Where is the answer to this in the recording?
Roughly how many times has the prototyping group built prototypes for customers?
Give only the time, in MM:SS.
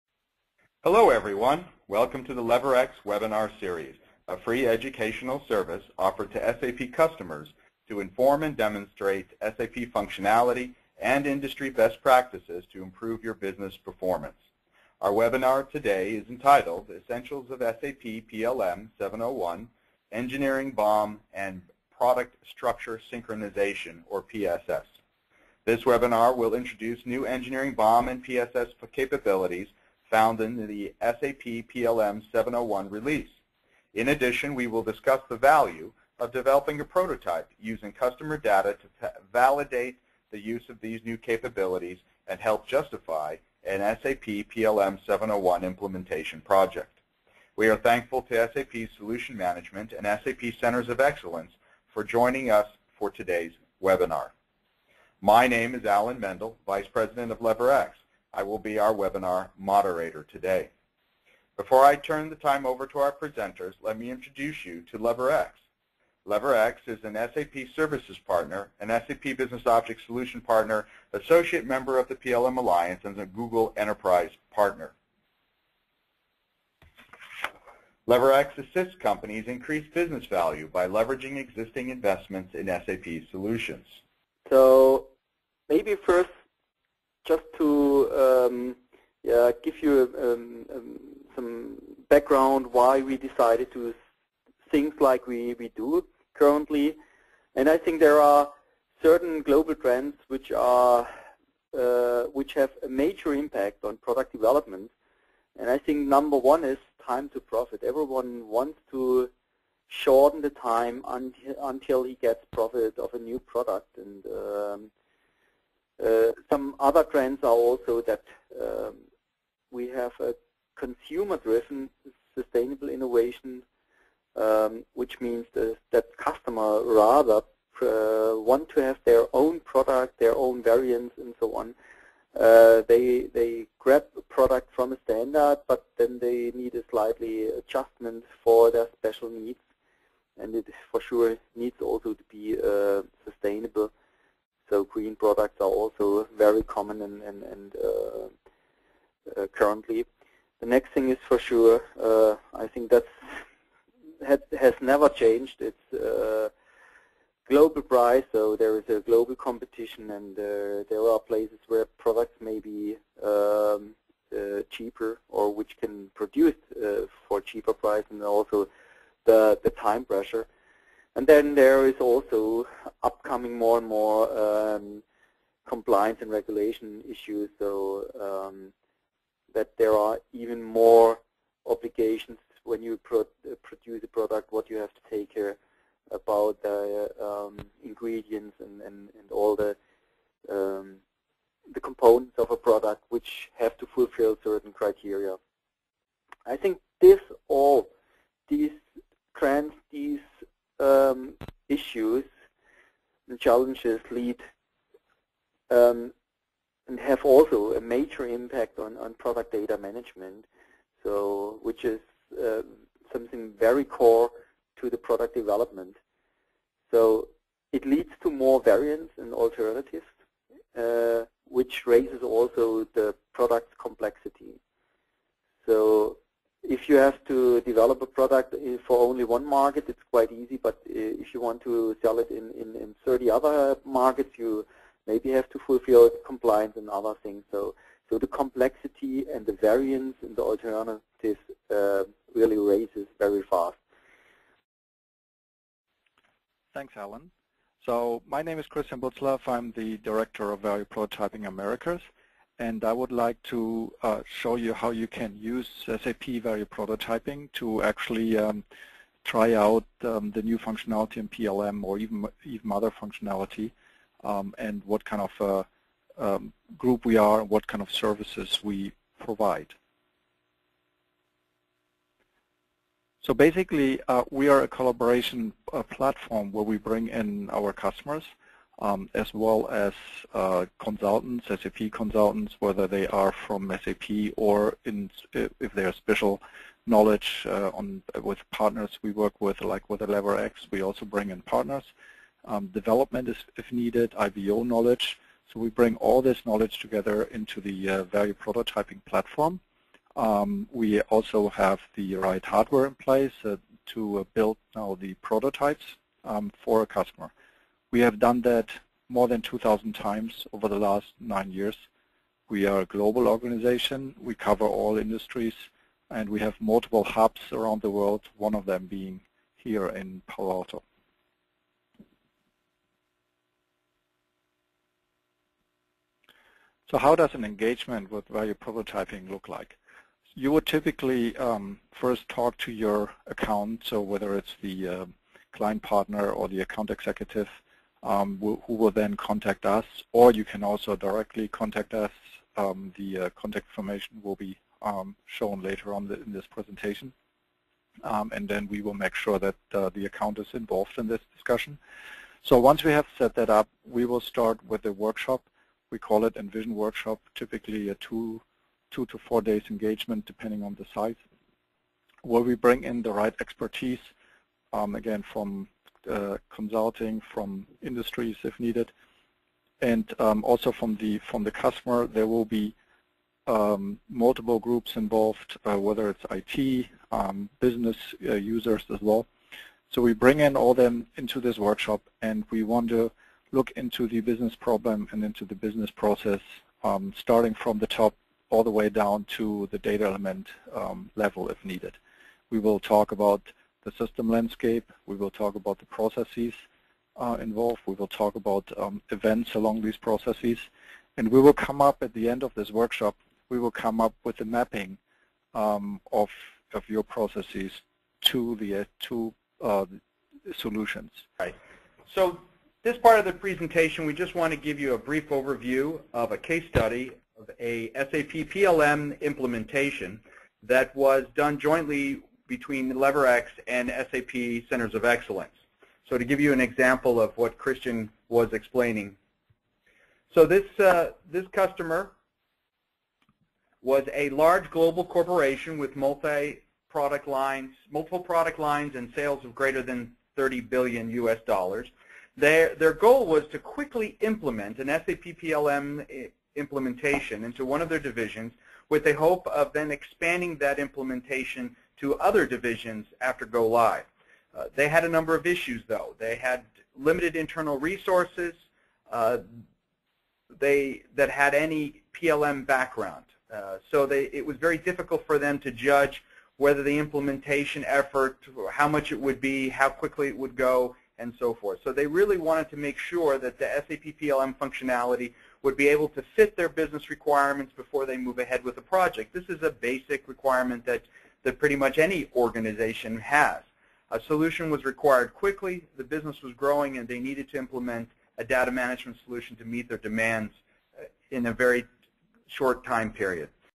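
05:09.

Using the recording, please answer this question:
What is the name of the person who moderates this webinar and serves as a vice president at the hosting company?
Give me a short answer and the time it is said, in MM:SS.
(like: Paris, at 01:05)
Alan Mendel, at 00:55.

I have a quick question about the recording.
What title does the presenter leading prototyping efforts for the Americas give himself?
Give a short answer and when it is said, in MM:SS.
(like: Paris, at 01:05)
Director of Value Prototyping Americas, at 04:09.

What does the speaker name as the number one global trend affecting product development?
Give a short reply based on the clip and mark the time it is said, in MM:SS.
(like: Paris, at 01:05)
Time to profit, at 01:47.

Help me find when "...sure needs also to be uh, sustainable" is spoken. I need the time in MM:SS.
02:21.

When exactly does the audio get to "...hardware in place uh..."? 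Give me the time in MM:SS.
05:02.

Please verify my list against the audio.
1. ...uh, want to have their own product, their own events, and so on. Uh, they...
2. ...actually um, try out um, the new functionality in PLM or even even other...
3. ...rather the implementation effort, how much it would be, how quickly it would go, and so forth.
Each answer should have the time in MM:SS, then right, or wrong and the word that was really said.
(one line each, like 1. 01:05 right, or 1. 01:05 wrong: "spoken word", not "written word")
1. 02:07 wrong: "variants", not "events"
2. 04:17 right
3. 07:46 wrong: "whether", not "rather".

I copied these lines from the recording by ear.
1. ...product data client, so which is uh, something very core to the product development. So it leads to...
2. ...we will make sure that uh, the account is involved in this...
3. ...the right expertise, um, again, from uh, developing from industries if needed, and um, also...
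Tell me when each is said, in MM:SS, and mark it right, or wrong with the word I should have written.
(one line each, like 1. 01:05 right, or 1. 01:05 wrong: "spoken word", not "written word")
1. 03:29 wrong: "management", not "client"
2. 05:48 right
3. 06:03 wrong: "consulting", not "developing".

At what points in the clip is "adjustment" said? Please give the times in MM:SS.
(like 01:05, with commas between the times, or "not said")
02:17.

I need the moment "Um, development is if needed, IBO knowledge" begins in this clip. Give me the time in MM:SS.
04:52.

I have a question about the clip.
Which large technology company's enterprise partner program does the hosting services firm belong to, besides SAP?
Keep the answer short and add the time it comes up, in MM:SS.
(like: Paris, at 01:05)
Google, at 01:13.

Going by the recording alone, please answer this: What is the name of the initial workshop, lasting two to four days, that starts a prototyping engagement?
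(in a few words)
Envision Workshop.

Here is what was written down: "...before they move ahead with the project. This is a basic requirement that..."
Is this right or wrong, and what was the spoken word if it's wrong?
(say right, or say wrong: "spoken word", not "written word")
right.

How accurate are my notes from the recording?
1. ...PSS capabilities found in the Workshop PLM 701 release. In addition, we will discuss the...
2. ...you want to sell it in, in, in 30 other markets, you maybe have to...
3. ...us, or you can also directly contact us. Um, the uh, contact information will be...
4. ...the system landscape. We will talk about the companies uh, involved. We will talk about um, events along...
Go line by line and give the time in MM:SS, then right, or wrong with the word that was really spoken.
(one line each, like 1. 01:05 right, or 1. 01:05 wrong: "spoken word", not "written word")
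1. 00:28 wrong: "SAP", not "Workshop"
2. 03:51 right
3. 05:39 right
4. 06:33 wrong: "processes", not "companies".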